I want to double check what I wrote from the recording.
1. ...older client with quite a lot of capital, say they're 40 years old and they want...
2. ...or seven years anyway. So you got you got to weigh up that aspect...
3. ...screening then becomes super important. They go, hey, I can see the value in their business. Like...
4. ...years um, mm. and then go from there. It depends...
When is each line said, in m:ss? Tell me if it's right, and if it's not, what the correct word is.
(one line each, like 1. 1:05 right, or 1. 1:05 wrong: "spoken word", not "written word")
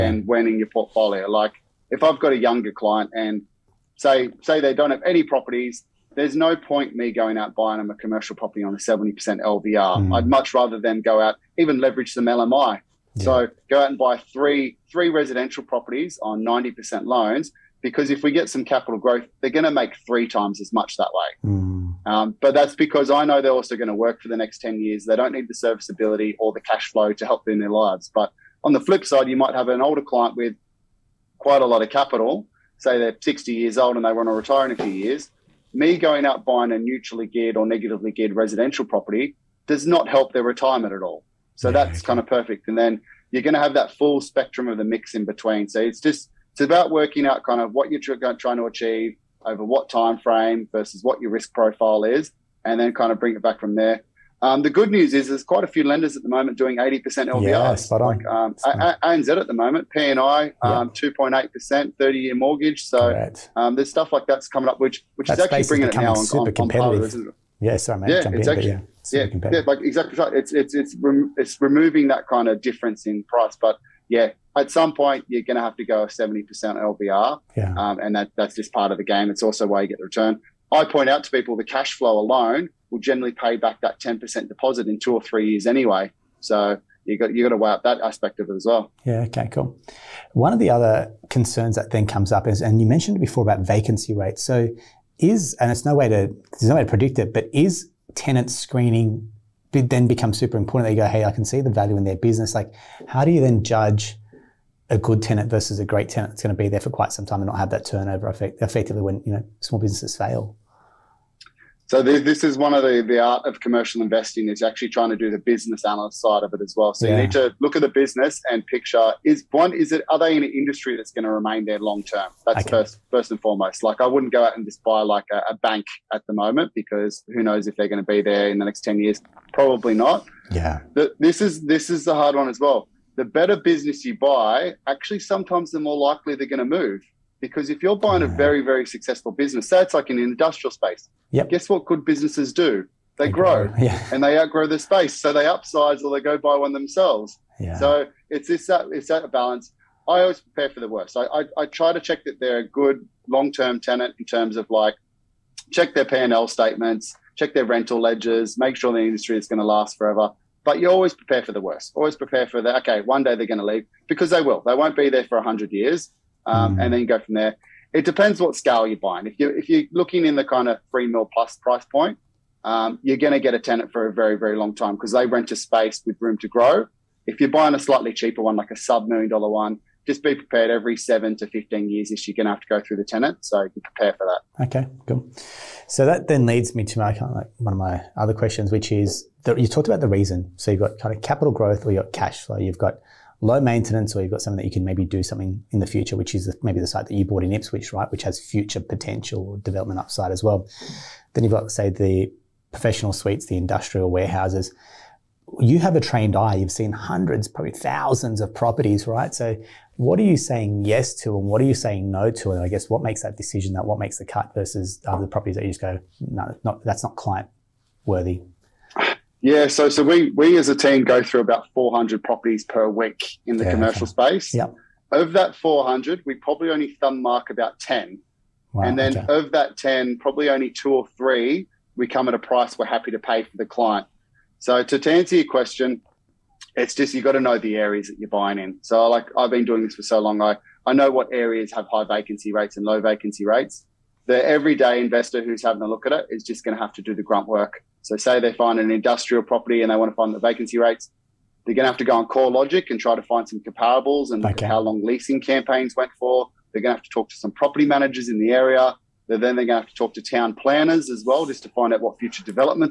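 1. 0:29 wrong: "60", not "40"
2. 1:25 wrong: "three", not "seven"
3. 1:38 right
4. 2:45 right.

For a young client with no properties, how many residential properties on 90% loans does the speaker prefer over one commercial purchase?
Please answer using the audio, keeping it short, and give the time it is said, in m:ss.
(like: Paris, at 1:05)
3, at 0:14.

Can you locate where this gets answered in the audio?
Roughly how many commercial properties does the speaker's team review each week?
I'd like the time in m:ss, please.
3:41.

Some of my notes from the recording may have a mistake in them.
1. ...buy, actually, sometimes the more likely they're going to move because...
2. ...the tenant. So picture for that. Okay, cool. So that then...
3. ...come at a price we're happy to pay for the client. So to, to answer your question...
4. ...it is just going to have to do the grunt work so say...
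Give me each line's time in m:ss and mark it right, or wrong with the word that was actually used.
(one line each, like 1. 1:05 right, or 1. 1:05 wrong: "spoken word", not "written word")
1. 2:14 right
2. 3:02 wrong: "prepare", not "picture"
3. 3:52 right
4. 4:06 right.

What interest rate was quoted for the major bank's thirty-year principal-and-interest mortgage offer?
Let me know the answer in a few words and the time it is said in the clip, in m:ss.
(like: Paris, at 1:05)
2.8%, at 1:01.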